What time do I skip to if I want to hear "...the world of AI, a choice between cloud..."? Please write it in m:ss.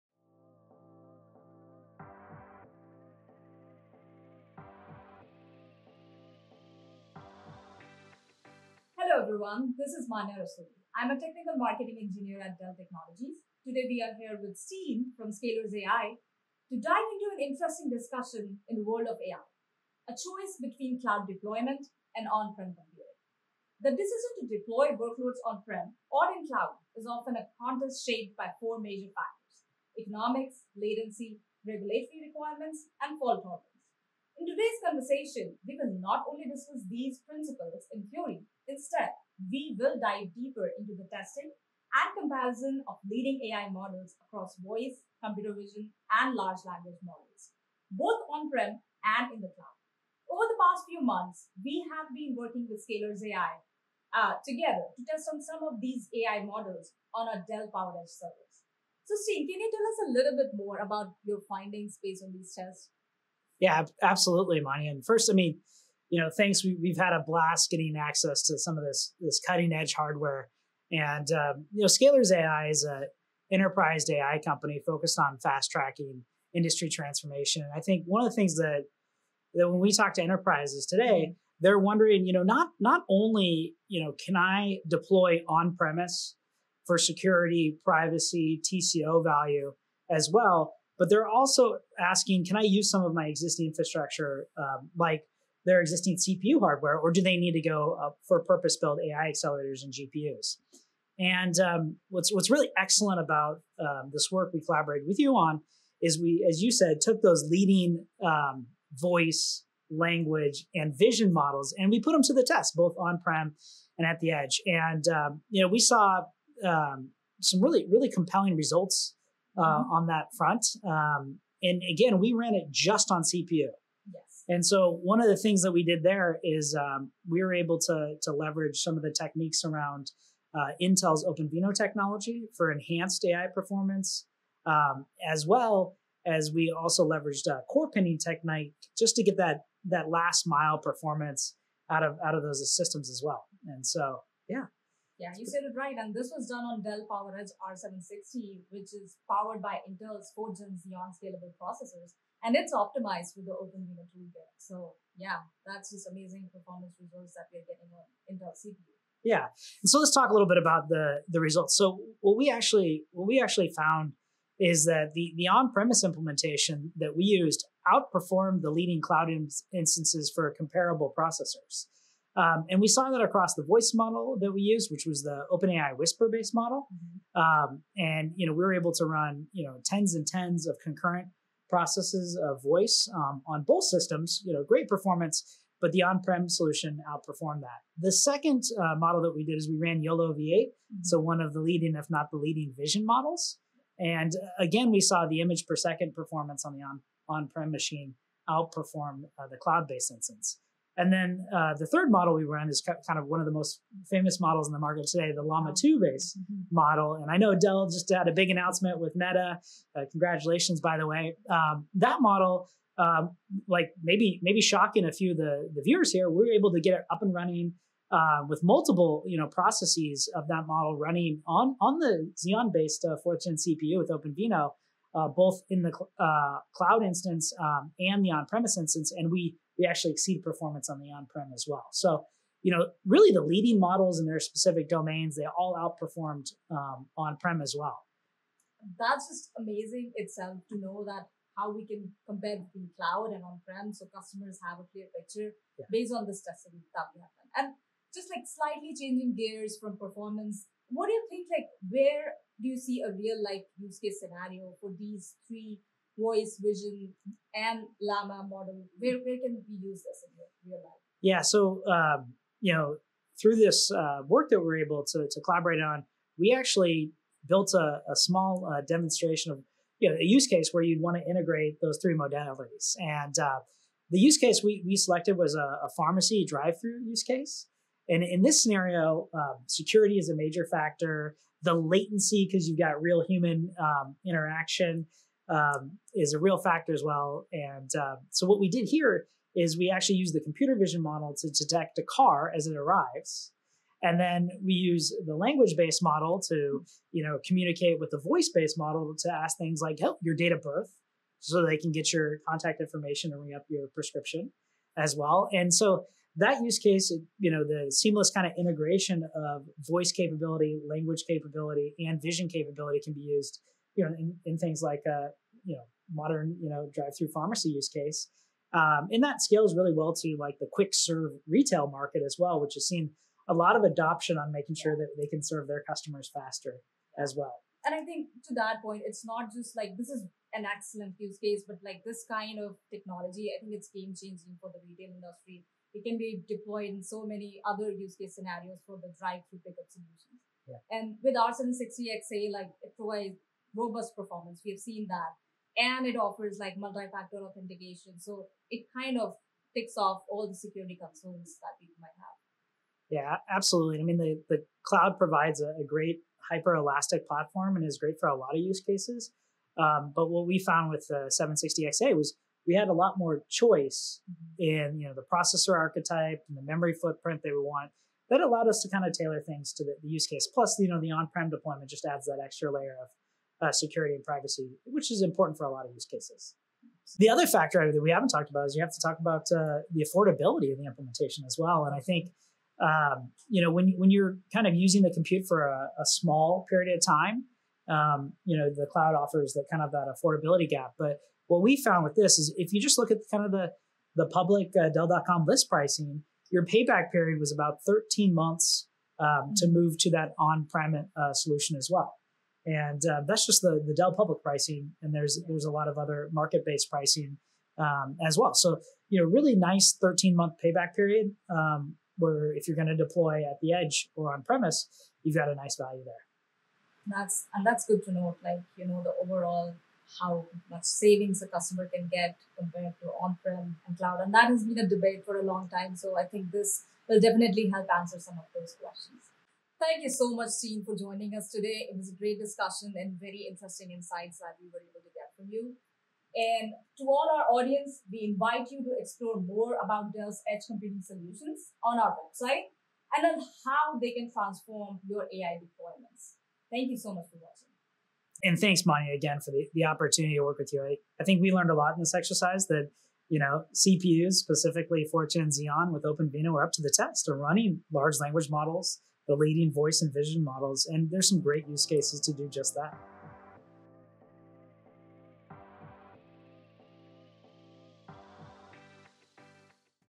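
0:18.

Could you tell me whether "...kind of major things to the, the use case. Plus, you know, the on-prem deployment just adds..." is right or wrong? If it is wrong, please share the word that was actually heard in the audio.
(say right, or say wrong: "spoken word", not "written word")
wrong: "tailor", not "major".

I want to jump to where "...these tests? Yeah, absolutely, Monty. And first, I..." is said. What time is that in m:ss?
1:02.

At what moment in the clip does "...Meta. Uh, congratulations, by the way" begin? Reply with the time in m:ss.
3:29.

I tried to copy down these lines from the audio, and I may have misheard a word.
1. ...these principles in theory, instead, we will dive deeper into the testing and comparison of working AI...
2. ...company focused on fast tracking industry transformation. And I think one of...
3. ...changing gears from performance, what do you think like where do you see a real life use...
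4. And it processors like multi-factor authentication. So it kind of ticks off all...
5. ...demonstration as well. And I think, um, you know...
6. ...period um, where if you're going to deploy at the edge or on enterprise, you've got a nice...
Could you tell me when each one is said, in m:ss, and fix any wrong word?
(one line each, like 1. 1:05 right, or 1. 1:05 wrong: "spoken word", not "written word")
1. 0:36 wrong: "leading", not "working"
2. 1:14 right
3. 4:08 right
4. 5:45 wrong: "offers", not "processors"
5. 6:20 wrong: "implementation", not "demonstration"
6. 6:50 wrong: "premise", not "enterprise".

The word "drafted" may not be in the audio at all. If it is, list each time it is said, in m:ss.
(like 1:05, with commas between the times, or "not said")
not said.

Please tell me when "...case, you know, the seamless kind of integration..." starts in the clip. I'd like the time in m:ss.
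5:06.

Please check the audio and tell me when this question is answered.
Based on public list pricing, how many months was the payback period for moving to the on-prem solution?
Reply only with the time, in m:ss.
6:37.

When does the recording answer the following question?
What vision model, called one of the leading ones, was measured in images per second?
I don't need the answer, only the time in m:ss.
3:10.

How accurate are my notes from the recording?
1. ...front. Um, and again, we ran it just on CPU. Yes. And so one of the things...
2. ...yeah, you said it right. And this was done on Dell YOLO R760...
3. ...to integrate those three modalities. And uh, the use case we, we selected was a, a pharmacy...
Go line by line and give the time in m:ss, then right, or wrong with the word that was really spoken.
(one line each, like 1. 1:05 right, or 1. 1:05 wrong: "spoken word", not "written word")
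1. 2:00 right
2. 2:25 wrong: "PowerEdge", not "YOLO"
3. 4:31 right.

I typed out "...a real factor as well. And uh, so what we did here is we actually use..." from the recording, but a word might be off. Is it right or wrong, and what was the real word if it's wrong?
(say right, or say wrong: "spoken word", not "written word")
right.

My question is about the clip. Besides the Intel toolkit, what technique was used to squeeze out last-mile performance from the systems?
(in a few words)
Core pinning.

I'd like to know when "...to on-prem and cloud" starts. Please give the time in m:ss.
7:03.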